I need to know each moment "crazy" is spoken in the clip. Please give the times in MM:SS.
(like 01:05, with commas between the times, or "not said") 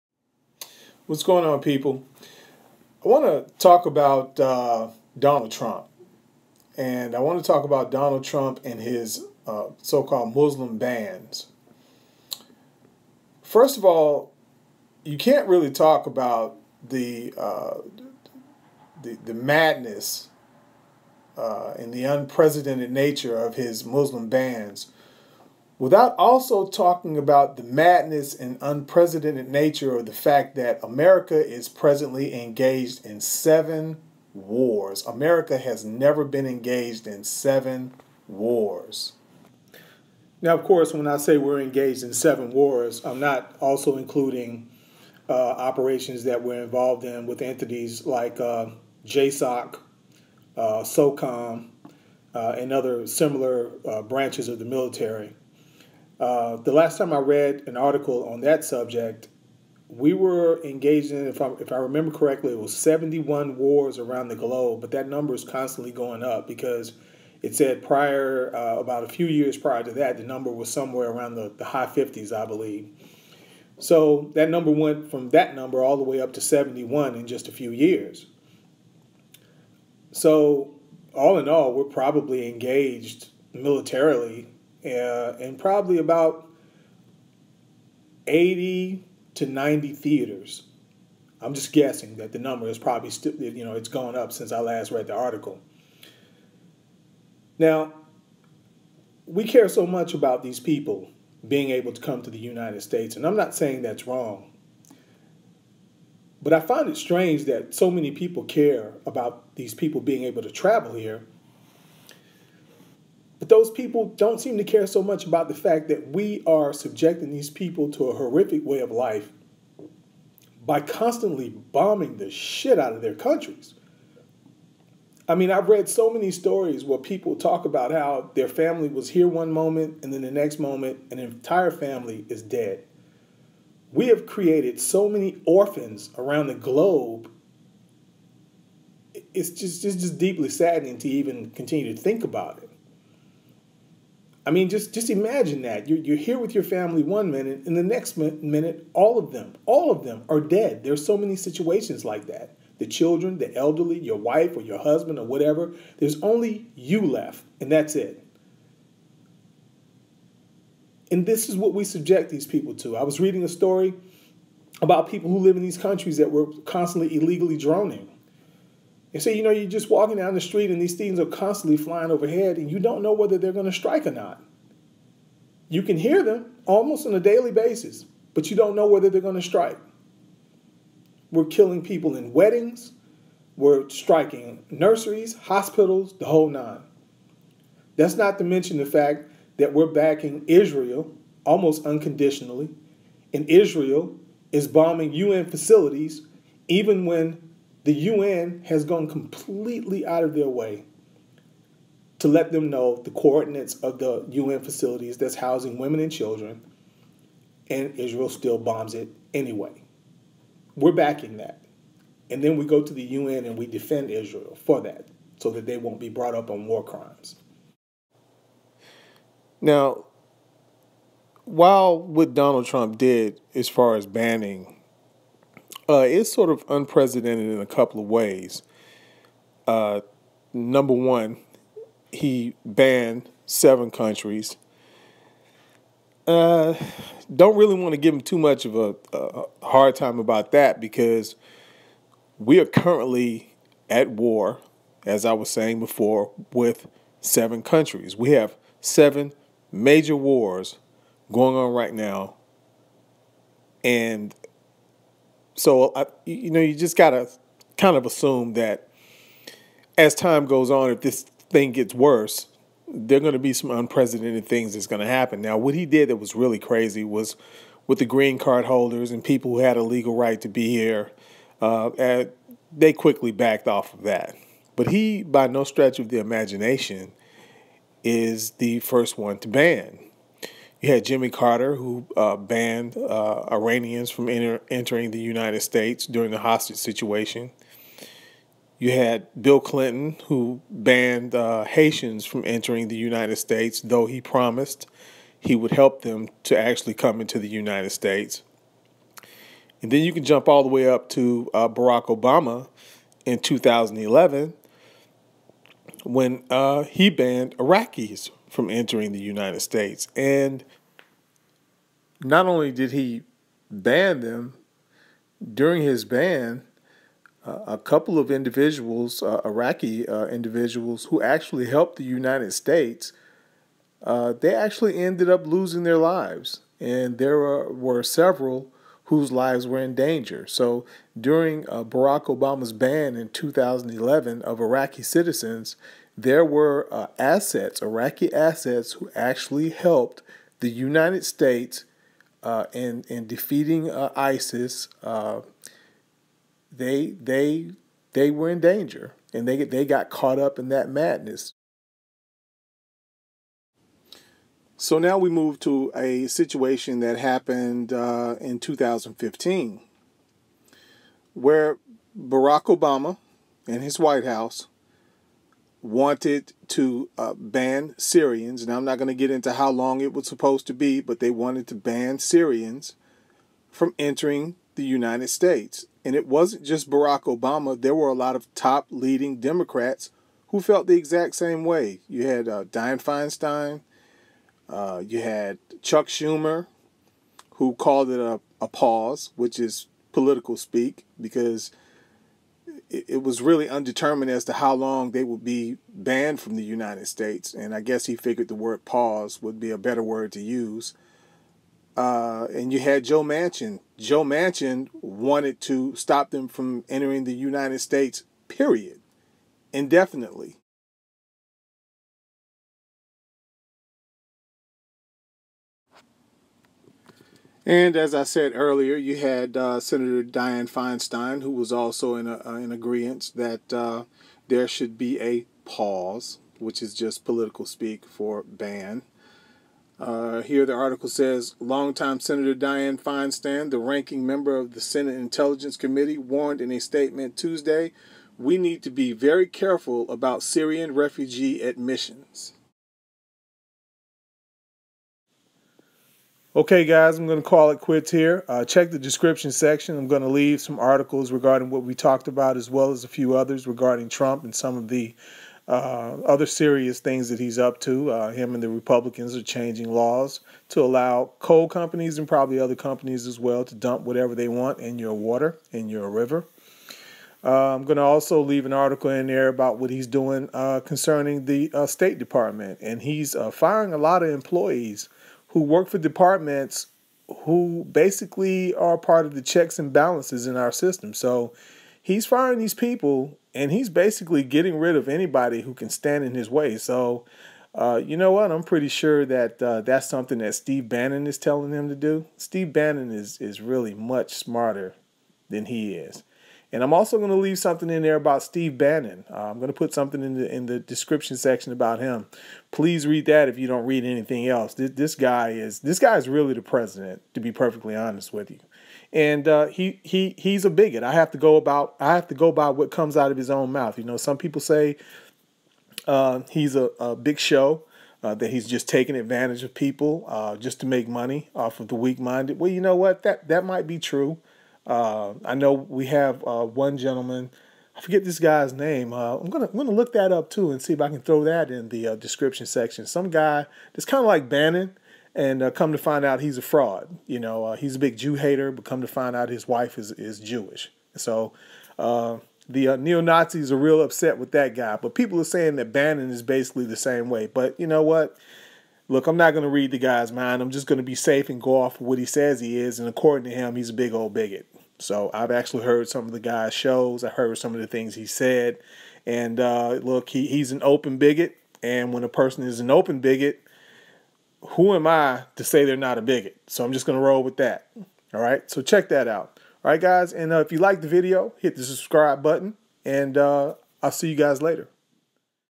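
04:26.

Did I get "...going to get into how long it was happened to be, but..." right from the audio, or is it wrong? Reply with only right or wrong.
wrong.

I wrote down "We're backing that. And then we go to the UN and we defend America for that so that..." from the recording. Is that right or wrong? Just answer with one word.
wrong.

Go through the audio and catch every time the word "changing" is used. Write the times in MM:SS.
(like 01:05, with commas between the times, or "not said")
07:39.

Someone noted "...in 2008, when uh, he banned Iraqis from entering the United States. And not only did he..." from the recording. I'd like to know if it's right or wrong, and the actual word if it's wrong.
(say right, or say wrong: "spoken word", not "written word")
wrong: "2011", not "2008".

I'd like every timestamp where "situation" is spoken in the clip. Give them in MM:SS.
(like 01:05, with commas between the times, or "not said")
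02:31, 04:46, 05:56.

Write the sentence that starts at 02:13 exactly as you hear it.
We have created so many orphans around the globe.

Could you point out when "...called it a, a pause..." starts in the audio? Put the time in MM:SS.
06:27.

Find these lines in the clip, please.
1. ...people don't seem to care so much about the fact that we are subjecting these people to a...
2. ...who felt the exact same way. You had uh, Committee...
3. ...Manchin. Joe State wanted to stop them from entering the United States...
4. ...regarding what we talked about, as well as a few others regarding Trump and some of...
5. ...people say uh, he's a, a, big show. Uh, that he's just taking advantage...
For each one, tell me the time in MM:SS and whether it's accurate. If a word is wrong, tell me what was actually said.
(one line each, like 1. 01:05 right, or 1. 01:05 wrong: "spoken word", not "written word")
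1. 01:53 right
2. 06:20 wrong: "Dianne", not "Committee"
3. 06:43 wrong: "Manchin", not "State"
4. 07:31 right
5. 08:34 right.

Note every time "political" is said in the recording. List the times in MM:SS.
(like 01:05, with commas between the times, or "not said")
06:30, 07:07.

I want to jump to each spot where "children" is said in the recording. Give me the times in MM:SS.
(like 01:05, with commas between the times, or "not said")
02:32, 03:26.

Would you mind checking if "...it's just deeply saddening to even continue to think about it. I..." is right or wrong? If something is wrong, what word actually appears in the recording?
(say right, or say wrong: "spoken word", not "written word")
right.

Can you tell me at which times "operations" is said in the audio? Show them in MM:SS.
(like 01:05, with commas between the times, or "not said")
00:45.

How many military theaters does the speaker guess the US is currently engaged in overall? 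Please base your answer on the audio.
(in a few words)
80 to 90.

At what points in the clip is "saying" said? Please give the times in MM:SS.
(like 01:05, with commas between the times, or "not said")
01:43, 04:05, 09:05.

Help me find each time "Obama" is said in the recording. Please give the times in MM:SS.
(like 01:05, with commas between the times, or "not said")
05:02, 05:32, 06:02, 06:17.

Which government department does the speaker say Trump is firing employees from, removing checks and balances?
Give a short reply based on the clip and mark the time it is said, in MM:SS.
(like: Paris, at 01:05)
State Department, at 07:51.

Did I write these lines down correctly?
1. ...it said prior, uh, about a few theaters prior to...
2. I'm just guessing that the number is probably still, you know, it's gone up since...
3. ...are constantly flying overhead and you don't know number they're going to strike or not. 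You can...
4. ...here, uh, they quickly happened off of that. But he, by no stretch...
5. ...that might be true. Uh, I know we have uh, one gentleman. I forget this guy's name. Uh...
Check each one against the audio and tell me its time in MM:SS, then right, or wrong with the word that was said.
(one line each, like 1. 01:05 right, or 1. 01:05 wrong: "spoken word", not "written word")
1. 01:07 wrong: "years", not "theaters"
2. 01:31 right
3. 02:51 wrong: "whether", not "number"
4. 04:30 wrong: "backed", not "happened"
5. 08:43 right.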